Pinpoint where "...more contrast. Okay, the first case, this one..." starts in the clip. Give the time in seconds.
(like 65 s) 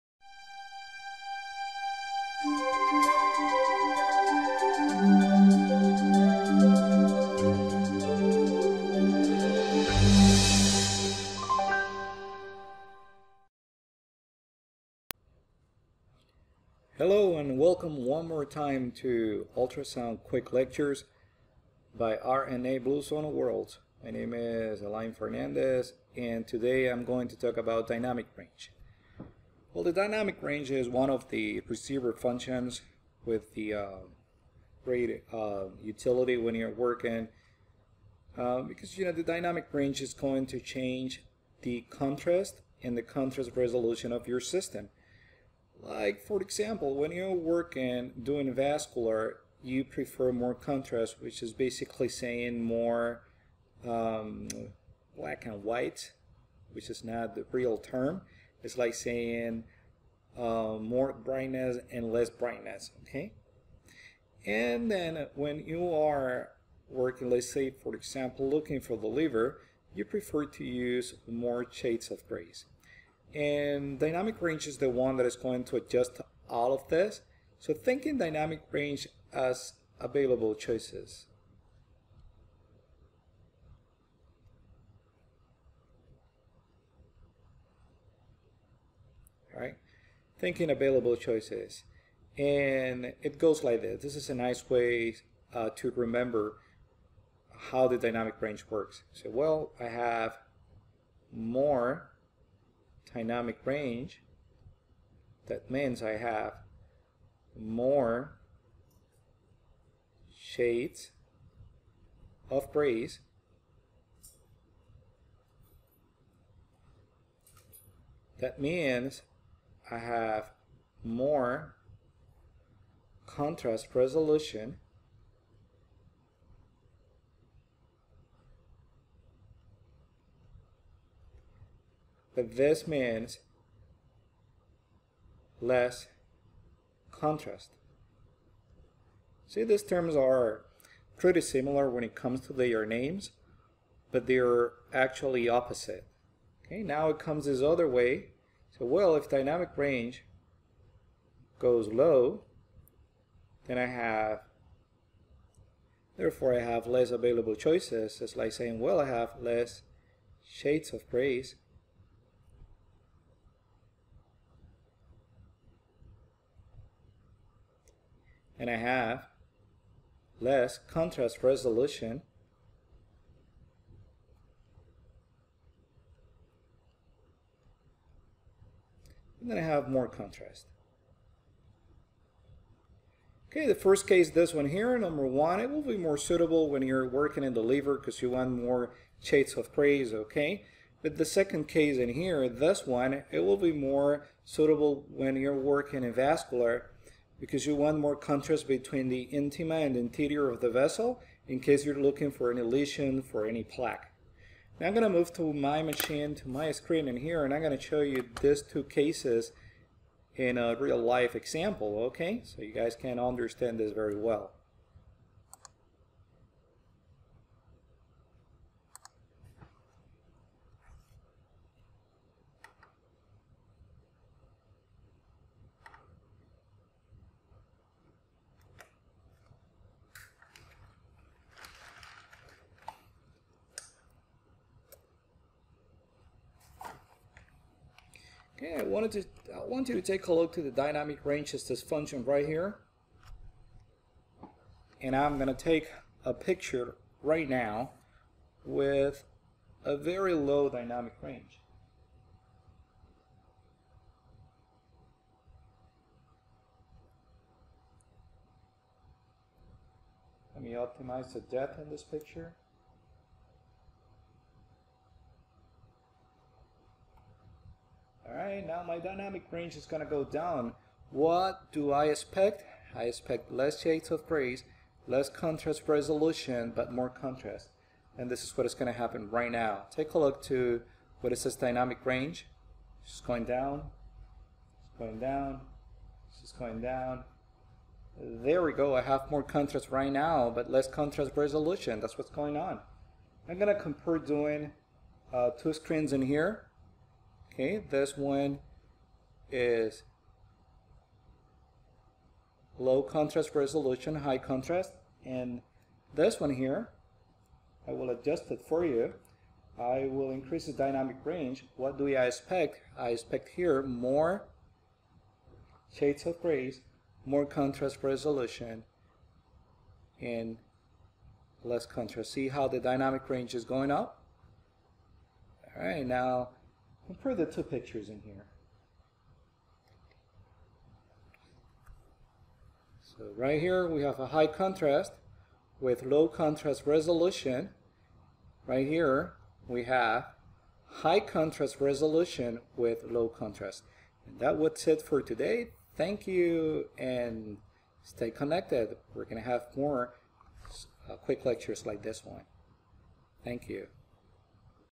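179 s.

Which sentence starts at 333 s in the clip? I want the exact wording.
So right here we have a high contrast with low contrast resolution.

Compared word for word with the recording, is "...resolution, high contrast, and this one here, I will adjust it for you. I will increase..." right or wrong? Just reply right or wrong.
right.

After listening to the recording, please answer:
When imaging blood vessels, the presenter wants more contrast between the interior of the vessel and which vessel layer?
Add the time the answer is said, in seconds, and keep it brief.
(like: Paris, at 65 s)
intima, at 199 s.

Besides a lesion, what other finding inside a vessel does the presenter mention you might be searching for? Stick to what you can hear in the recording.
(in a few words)
plaque.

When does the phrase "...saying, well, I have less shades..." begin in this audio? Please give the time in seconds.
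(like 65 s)
158 s.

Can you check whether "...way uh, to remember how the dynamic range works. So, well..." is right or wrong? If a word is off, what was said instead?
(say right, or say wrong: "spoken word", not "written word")
right.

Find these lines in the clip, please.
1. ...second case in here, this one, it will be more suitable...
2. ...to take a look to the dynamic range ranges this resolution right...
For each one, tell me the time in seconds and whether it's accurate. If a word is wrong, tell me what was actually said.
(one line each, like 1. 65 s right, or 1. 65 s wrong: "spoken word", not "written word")
1. 191 s right
2. 239 s wrong: "function", not "resolution".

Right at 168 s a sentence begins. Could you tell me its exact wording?
And I have less contrast resolution.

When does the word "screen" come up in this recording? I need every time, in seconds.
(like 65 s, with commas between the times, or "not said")
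206 s, 295 s.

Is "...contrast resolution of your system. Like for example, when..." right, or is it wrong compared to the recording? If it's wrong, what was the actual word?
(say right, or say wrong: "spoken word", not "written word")
right.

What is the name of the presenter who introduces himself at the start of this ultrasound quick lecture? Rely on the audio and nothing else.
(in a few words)
Alain Fernandez.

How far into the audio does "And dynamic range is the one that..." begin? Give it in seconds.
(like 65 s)
73 s.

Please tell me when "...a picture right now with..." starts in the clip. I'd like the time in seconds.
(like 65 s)
246 s.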